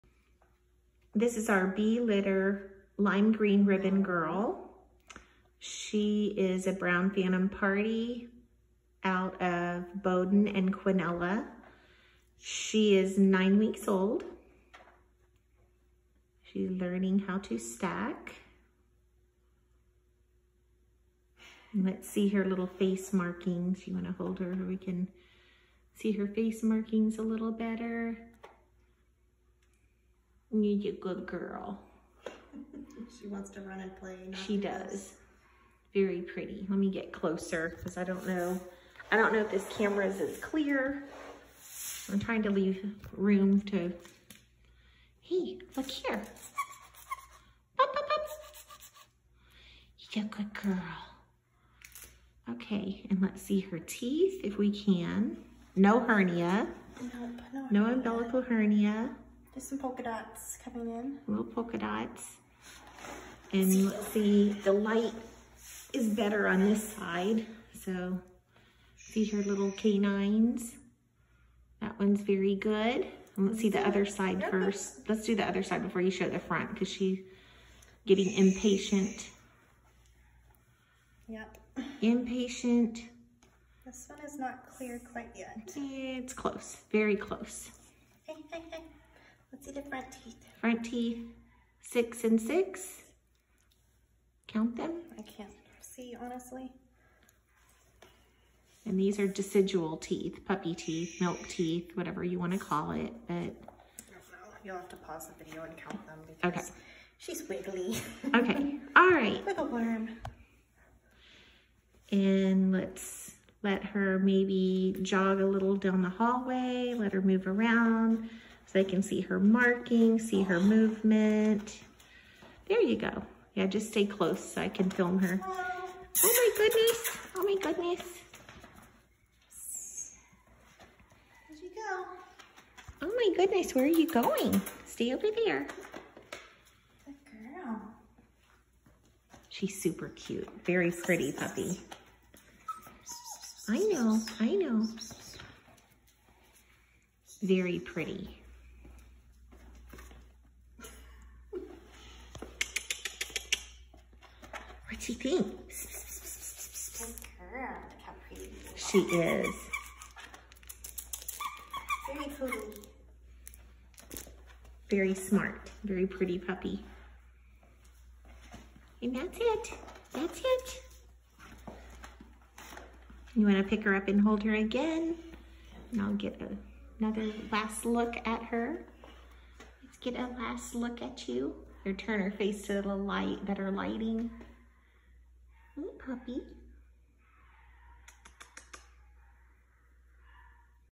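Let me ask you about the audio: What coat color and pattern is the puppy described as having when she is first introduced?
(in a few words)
Brown Phantom Parti.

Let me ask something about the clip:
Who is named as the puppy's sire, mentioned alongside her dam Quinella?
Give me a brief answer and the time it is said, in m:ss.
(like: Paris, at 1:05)
Bohdan, at 0:10.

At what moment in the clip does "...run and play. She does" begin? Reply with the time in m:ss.
0:33.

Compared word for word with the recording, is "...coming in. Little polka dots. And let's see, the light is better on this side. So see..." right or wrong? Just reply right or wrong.
right.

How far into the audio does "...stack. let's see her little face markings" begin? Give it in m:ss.
0:17.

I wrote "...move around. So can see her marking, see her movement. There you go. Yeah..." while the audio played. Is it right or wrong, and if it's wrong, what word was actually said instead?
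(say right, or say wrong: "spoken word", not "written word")
right.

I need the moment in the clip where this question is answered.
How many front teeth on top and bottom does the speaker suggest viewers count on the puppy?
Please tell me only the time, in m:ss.
1:31.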